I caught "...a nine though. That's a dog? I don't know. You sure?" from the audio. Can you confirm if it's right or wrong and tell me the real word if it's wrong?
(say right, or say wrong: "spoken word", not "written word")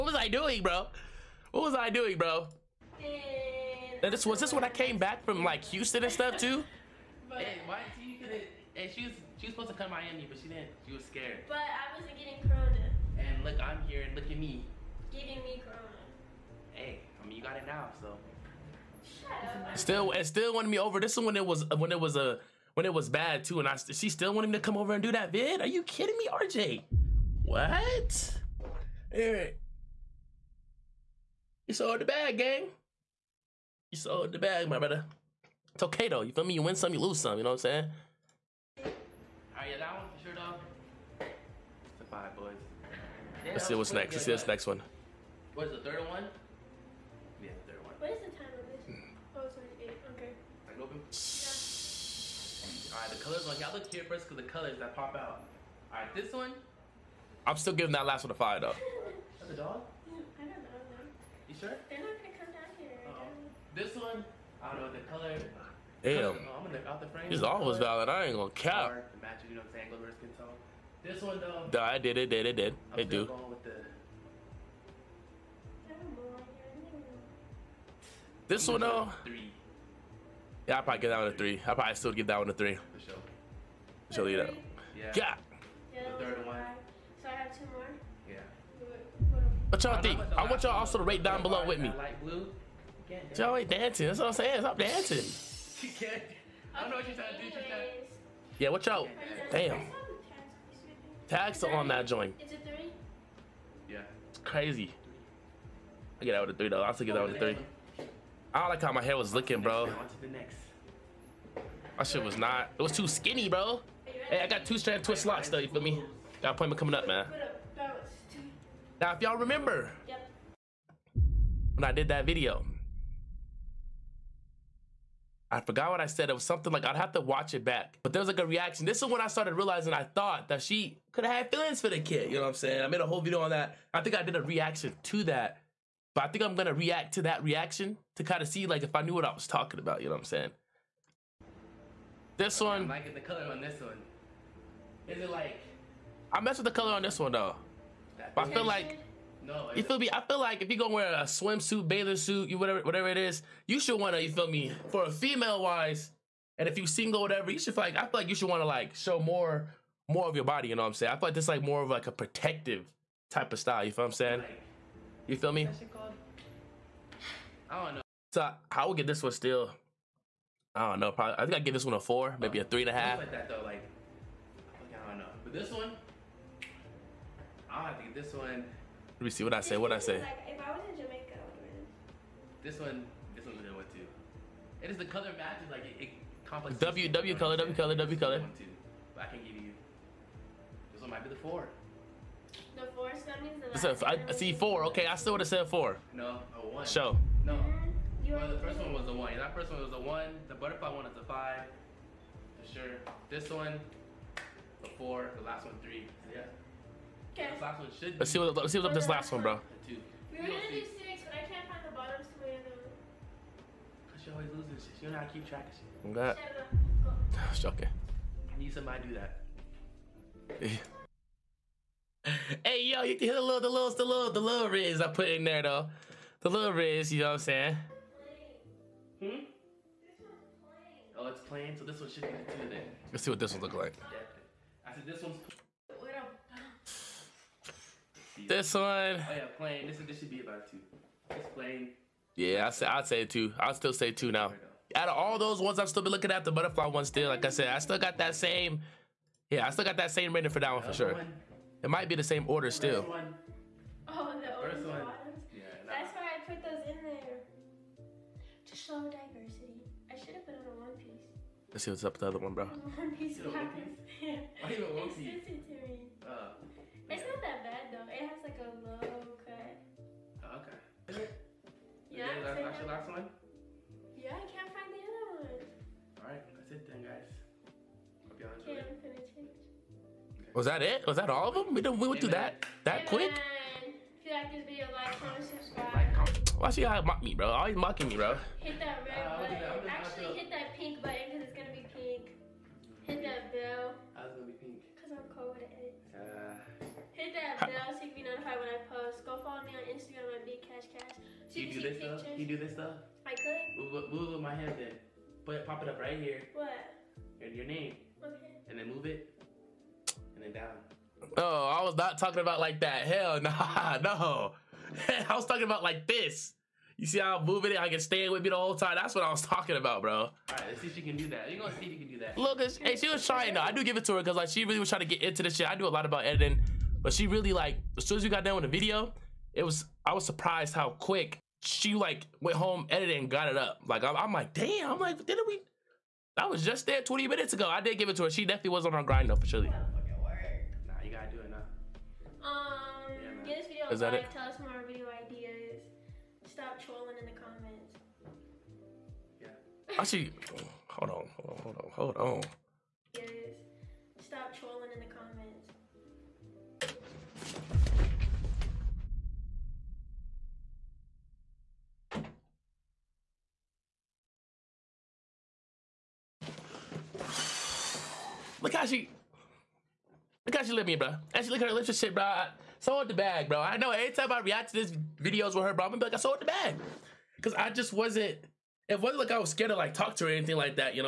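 wrong: "five", not "nine".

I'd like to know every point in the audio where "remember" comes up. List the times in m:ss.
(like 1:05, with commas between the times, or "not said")
1:59.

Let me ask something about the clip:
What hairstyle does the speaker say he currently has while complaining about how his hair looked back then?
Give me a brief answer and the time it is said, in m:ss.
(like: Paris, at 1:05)
Two strand twist locks, at 1:54.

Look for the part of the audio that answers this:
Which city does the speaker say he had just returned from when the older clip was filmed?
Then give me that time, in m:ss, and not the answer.
0:05.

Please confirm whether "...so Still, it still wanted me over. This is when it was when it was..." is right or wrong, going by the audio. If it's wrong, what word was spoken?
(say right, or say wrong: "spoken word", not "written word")
right.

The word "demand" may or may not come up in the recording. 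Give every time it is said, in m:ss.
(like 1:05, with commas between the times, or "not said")
not said.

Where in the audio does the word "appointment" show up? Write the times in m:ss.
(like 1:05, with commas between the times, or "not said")
1:56.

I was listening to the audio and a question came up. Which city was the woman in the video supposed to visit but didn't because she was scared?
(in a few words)
Miami.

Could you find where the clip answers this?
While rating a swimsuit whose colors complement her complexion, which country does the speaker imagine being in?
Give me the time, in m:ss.
3:00.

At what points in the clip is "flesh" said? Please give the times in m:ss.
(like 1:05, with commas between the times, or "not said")
not said.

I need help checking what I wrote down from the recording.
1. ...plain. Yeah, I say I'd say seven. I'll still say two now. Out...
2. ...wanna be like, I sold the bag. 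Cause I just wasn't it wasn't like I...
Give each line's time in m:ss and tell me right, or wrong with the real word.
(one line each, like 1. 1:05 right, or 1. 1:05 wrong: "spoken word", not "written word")
1. 4:01 wrong: "two", not "seven"
2. 6:15 wrong: "gonna", not "wanna".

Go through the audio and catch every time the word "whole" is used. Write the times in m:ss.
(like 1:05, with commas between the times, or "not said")
2:13, 5:18.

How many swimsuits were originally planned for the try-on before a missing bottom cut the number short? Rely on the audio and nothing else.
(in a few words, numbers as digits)
6.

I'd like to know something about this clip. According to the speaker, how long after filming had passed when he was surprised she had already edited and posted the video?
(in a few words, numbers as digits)
20 minutes.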